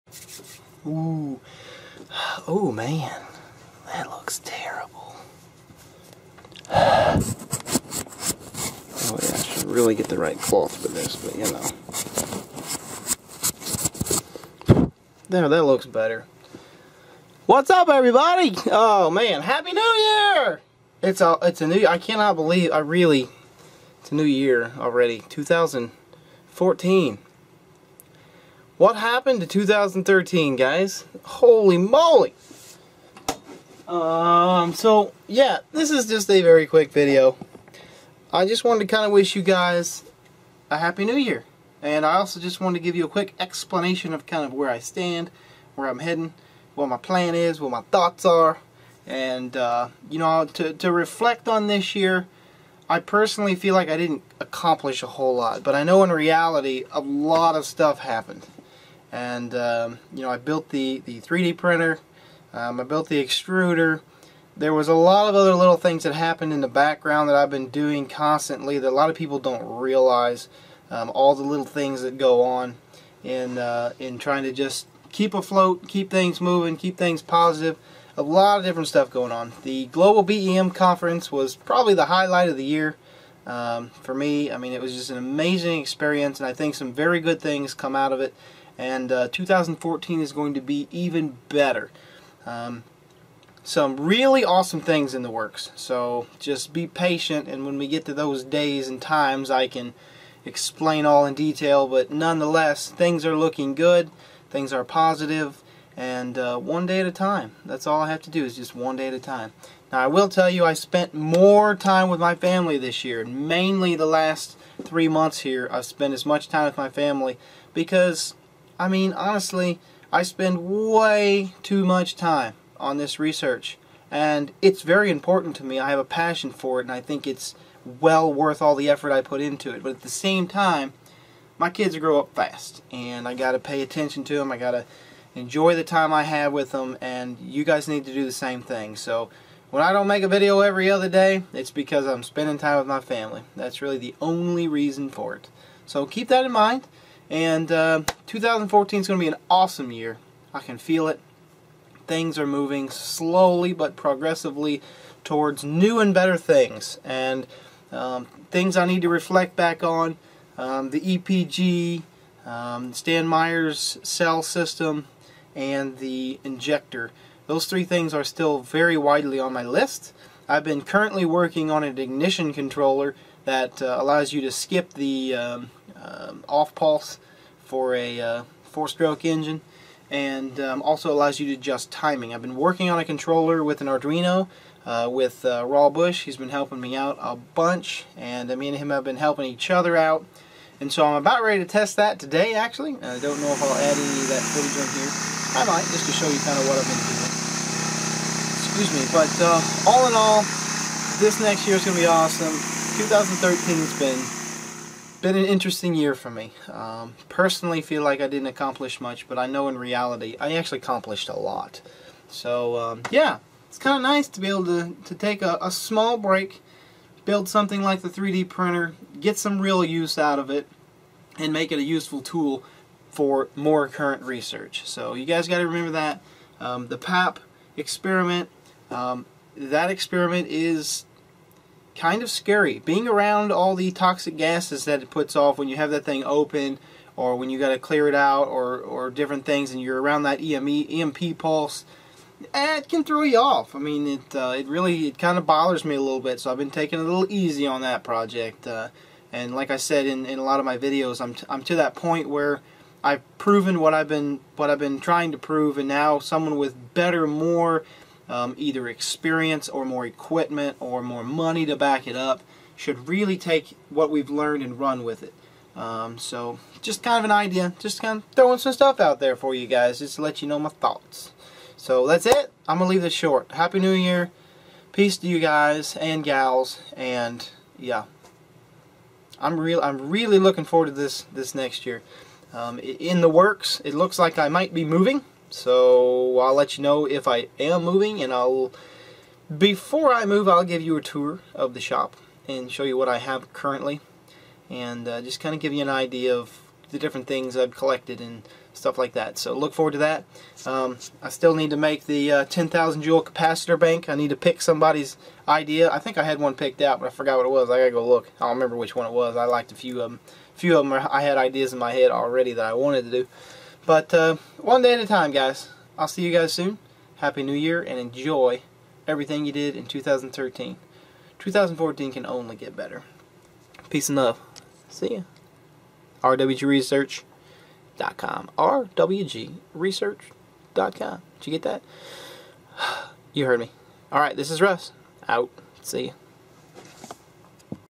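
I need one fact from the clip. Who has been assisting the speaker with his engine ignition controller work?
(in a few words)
Raw Bush.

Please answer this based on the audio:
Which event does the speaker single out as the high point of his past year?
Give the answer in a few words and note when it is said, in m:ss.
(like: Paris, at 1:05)
Global BEM conference, at 1:19.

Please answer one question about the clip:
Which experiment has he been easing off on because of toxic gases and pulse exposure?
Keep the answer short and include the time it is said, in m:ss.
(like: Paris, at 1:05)
The Papp experiment, at 3:46.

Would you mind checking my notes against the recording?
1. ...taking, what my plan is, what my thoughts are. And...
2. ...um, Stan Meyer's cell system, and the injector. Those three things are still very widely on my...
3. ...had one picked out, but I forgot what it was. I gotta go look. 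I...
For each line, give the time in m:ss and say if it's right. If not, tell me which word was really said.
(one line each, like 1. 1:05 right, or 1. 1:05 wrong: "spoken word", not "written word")
1. 0:45 wrong: "heading", not "taking"
2. 2:42 right
3. 5:06 right.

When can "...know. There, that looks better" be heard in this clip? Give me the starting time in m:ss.
0:14.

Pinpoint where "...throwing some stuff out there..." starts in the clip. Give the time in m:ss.
4:28.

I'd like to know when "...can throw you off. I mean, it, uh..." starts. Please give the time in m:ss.
4:02.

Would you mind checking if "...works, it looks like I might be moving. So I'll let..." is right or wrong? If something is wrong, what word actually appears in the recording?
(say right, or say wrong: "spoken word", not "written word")
right.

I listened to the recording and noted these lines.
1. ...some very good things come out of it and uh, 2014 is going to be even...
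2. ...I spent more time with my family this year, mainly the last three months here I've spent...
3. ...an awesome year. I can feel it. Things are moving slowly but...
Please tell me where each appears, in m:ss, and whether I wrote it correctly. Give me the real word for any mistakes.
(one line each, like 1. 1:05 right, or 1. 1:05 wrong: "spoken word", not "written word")
1. 1:26 right
2. 1:50 right
3. 2:29 right.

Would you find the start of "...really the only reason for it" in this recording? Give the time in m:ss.
2:23.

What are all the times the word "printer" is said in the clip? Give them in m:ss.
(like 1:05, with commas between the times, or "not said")
1:01, 3:38.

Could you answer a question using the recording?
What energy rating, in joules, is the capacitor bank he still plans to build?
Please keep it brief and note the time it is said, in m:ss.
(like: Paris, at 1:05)
10,000, at 5:02.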